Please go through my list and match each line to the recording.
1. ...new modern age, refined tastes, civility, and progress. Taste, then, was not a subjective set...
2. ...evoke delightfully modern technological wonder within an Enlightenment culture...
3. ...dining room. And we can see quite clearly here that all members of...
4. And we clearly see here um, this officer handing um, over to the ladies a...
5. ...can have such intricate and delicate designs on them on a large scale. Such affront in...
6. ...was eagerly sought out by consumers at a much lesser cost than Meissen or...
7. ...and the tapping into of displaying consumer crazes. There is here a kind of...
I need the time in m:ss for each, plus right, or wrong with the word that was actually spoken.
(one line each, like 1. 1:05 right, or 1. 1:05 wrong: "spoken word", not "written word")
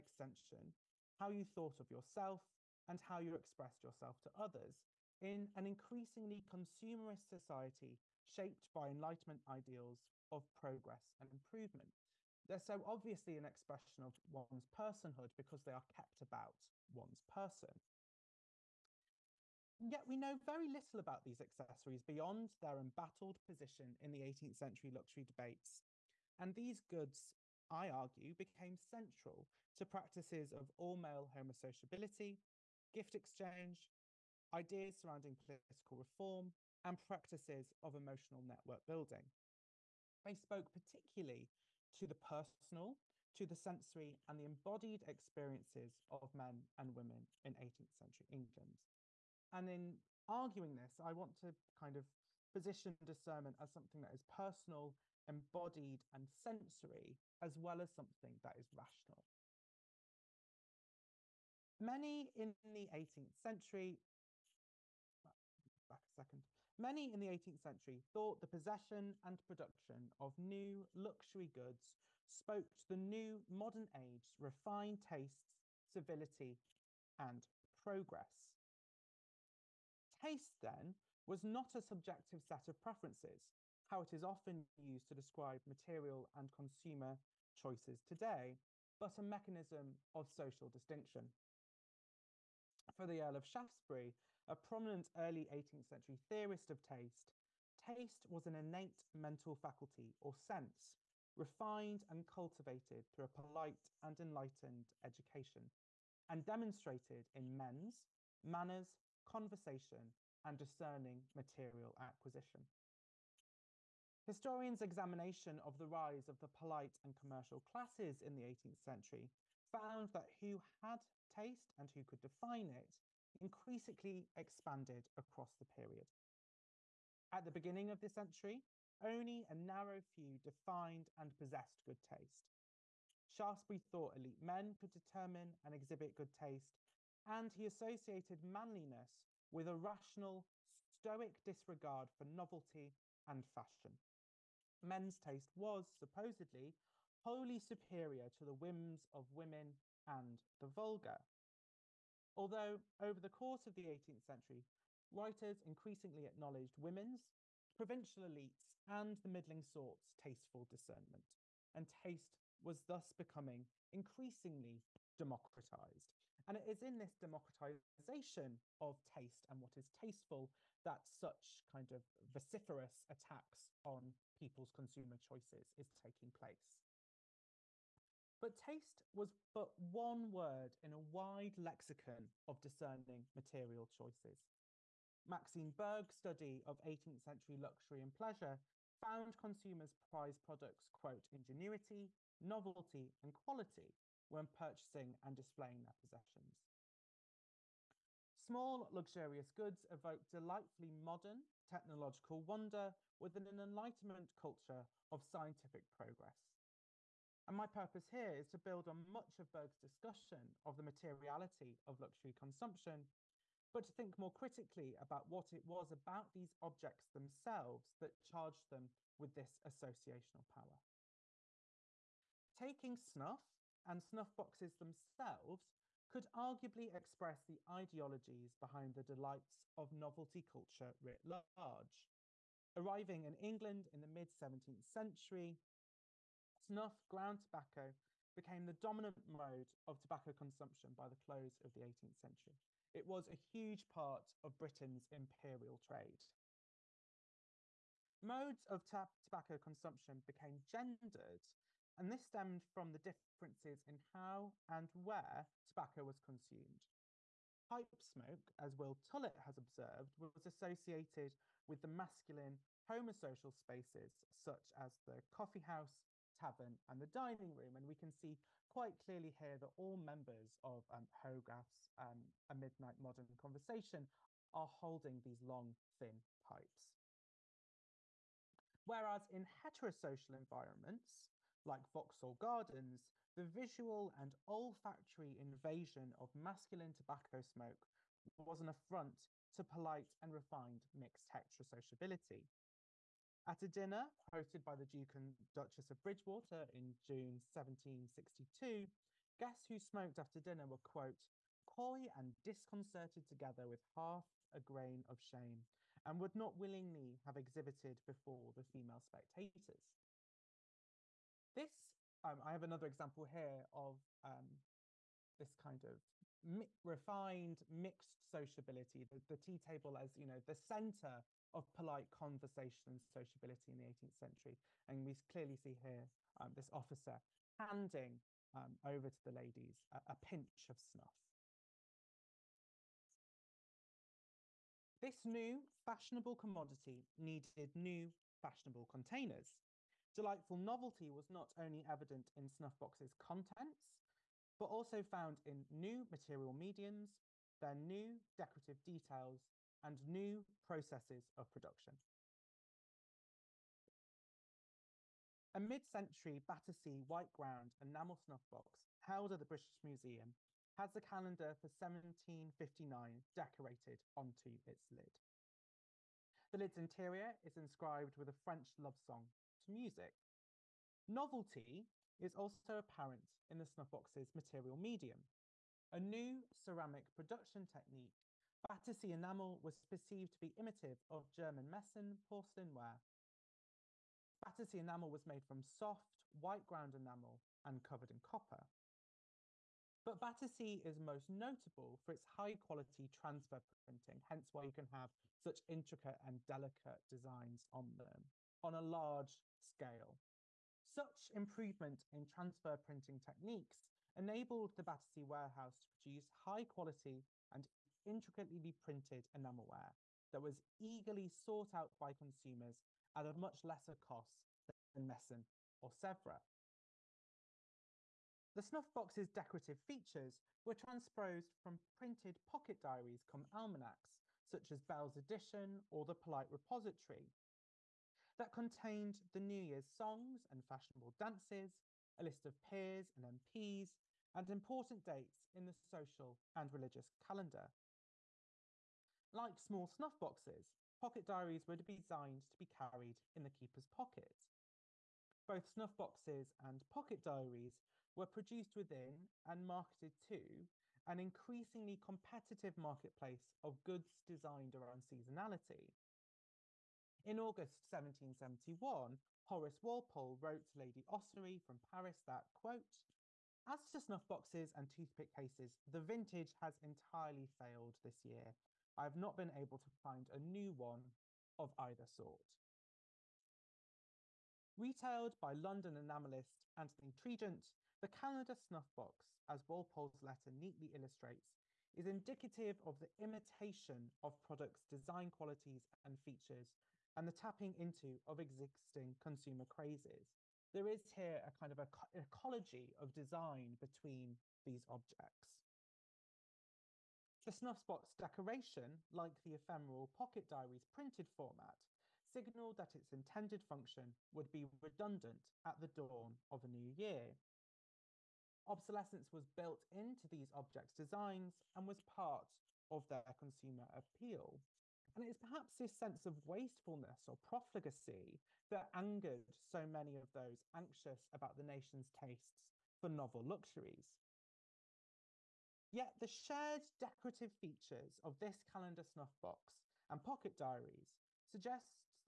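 1. 1:12 right
2. 3:19 right
3. 4:27 right
4. 5:24 right
5. 6:34 wrong: "improvement", not "affront"
6. 6:50 right
7. 8:07 wrong: "existing", not "displaying".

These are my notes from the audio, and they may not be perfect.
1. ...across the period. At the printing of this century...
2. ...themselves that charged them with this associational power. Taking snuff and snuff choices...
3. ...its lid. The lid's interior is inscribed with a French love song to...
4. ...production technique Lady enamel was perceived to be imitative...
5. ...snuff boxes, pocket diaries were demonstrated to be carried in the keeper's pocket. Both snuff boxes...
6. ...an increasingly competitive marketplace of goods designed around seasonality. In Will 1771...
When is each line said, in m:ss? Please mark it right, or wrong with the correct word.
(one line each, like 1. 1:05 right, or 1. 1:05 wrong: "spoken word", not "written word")
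1. 2:05 wrong: "beginning", not "printing"
2. 3:37 wrong: "boxes", not "choices"
3. 6:04 right
4. 6:17 wrong: "Battersea", not "Lady"
5. 7:19 wrong: "designed", not "demonstrated"
6. 7:31 wrong: "August", not "Will".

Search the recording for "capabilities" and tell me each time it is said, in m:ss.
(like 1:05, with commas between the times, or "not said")
not said.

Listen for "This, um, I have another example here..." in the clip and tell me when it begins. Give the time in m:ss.
5:11.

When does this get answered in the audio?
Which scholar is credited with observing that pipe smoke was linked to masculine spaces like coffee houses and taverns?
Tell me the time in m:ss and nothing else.
4:18.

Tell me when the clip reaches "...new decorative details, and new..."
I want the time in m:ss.
5:47.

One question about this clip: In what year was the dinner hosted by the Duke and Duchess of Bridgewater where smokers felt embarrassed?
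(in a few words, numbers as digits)
1762.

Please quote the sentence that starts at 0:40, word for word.
They spoke particularly to the personal, to the sensory, and the embodied experiences of men and women in 18th century England.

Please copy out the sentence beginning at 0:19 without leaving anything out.
Yet we know very little about these accessories beyond their embattled position in the 18th century luxury debates.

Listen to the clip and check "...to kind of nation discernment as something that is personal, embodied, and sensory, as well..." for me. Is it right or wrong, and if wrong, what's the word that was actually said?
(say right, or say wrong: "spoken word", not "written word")
wrong: "position", not "nation".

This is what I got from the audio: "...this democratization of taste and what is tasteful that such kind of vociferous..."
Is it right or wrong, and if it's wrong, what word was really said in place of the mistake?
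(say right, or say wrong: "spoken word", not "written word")
right.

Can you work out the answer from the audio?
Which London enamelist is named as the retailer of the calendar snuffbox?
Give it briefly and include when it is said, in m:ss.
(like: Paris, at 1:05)
Anthony Tregent, at 7:56.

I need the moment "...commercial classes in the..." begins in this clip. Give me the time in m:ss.
1:57.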